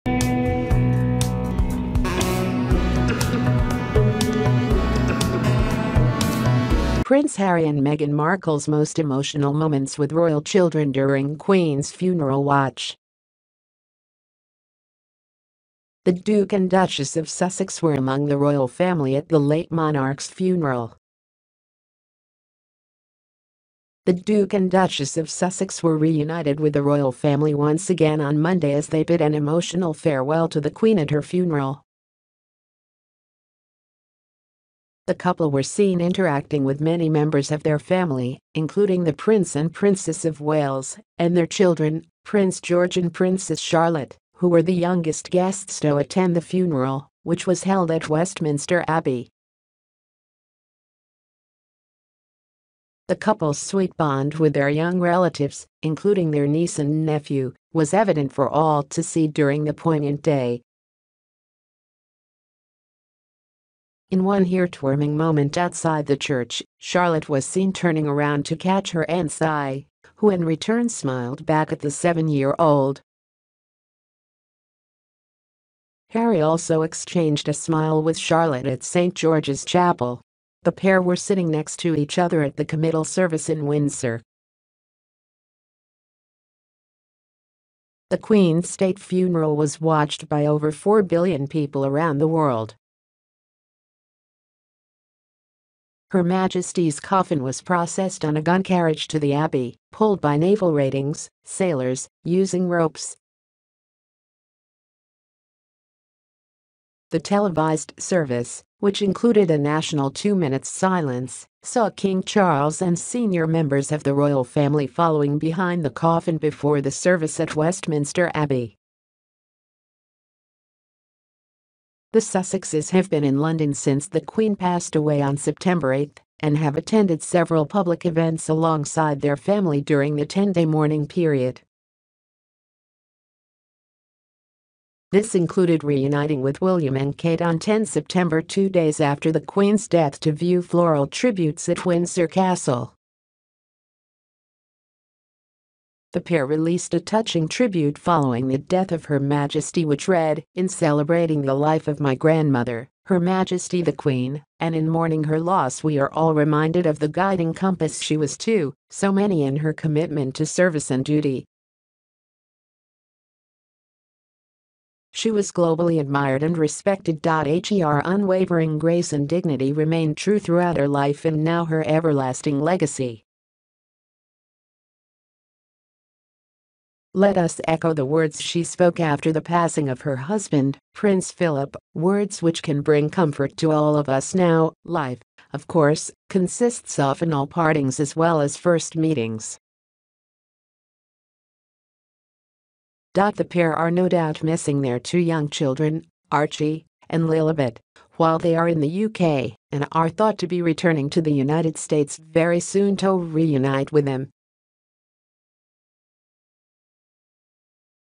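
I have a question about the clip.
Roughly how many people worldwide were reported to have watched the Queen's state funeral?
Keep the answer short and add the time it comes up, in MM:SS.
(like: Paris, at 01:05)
over 4 billion, at 01:30.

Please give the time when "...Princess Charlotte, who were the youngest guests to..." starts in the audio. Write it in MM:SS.
00:43.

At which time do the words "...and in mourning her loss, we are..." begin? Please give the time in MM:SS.
02:34.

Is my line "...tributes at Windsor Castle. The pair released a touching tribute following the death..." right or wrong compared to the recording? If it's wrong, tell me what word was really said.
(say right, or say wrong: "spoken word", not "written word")
right.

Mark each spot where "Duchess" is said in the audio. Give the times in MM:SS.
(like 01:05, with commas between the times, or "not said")
00:16, 00:24.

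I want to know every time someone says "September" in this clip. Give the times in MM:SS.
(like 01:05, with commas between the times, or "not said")
02:05, 02:17.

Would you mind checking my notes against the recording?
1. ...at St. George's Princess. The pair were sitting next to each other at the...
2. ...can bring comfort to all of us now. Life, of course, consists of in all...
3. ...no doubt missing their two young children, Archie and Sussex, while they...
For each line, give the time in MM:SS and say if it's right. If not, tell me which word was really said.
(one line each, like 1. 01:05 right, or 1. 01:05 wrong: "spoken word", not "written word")
1. 01:18 wrong: "Chapel", not "Princess"
2. 03:02 right
3. 03:13 wrong: "Lilibet", not "Sussex".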